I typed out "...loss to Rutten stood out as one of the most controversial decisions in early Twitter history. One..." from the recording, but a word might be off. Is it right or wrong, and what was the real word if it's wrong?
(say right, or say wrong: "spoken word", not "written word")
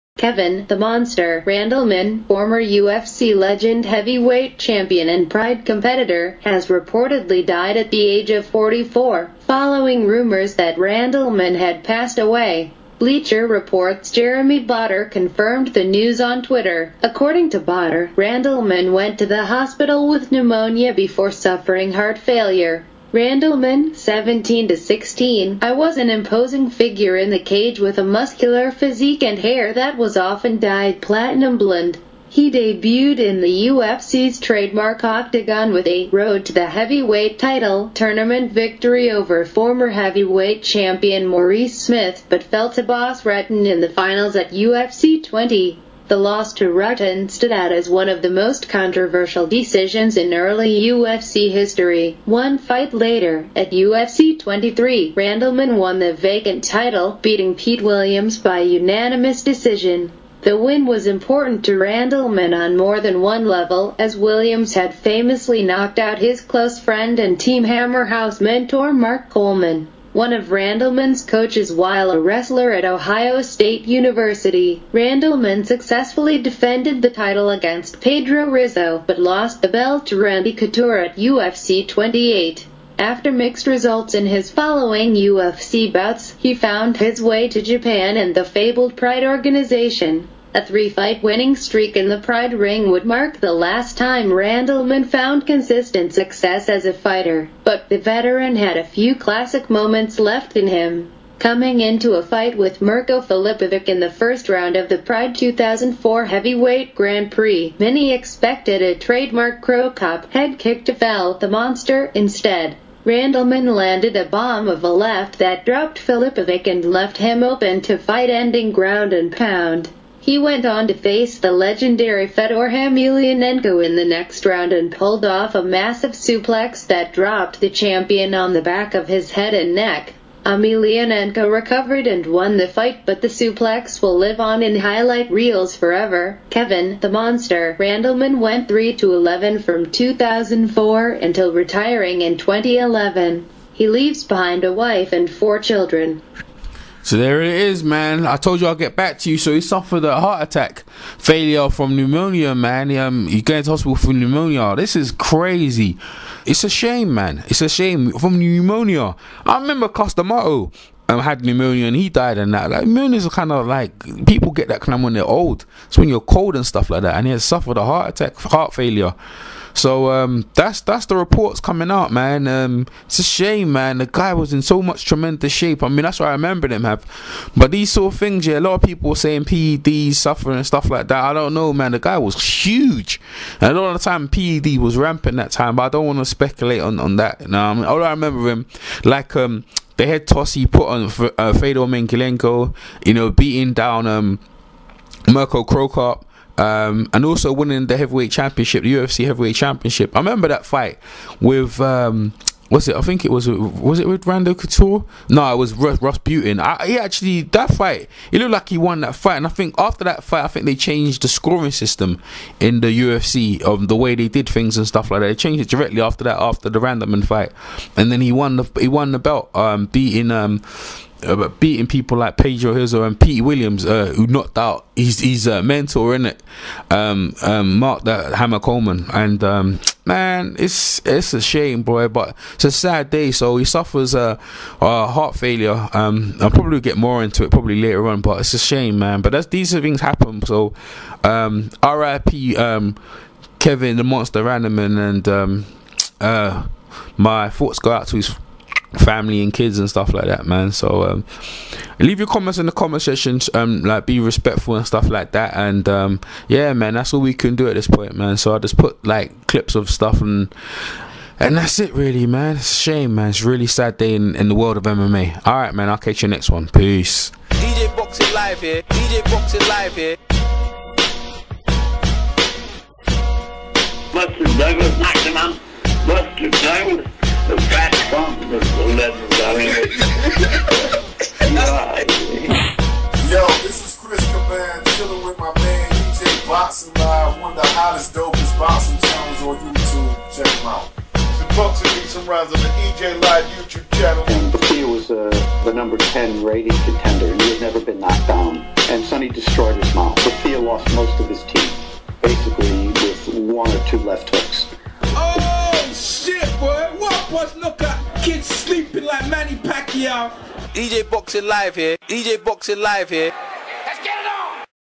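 wrong: "UFC", not "Twitter".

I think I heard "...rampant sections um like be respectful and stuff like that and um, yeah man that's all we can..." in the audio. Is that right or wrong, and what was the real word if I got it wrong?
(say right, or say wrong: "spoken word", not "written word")
wrong: "comment", not "rampant".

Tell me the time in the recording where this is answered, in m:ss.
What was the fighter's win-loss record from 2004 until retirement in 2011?
2:18.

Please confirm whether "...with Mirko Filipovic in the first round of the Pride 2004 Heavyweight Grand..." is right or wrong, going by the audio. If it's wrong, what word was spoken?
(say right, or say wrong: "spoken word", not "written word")
right.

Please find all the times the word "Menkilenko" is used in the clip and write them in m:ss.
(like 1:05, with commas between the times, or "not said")
3:11.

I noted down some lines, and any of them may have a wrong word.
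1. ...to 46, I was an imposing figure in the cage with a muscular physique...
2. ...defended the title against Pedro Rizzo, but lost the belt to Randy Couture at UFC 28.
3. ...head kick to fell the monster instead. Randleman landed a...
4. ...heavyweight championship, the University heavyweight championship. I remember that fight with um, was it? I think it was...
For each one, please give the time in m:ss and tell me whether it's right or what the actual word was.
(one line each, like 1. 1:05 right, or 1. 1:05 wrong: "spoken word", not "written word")
1. 0:24 wrong: "16", not "46"
2. 1:16 right
3. 1:50 right
4. 3:17 wrong: "UFC", not "University".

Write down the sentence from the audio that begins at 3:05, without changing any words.
But I don't want to speculate on on that.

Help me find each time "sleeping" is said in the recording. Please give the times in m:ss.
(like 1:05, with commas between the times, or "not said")
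5:08.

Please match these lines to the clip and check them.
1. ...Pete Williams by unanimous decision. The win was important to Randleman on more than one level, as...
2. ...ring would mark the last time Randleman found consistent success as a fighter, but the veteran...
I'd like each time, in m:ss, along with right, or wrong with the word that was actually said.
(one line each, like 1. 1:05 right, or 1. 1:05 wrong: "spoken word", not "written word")
1. 0:57 right
2. 1:32 right.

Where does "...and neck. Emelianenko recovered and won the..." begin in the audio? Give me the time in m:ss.
2:09.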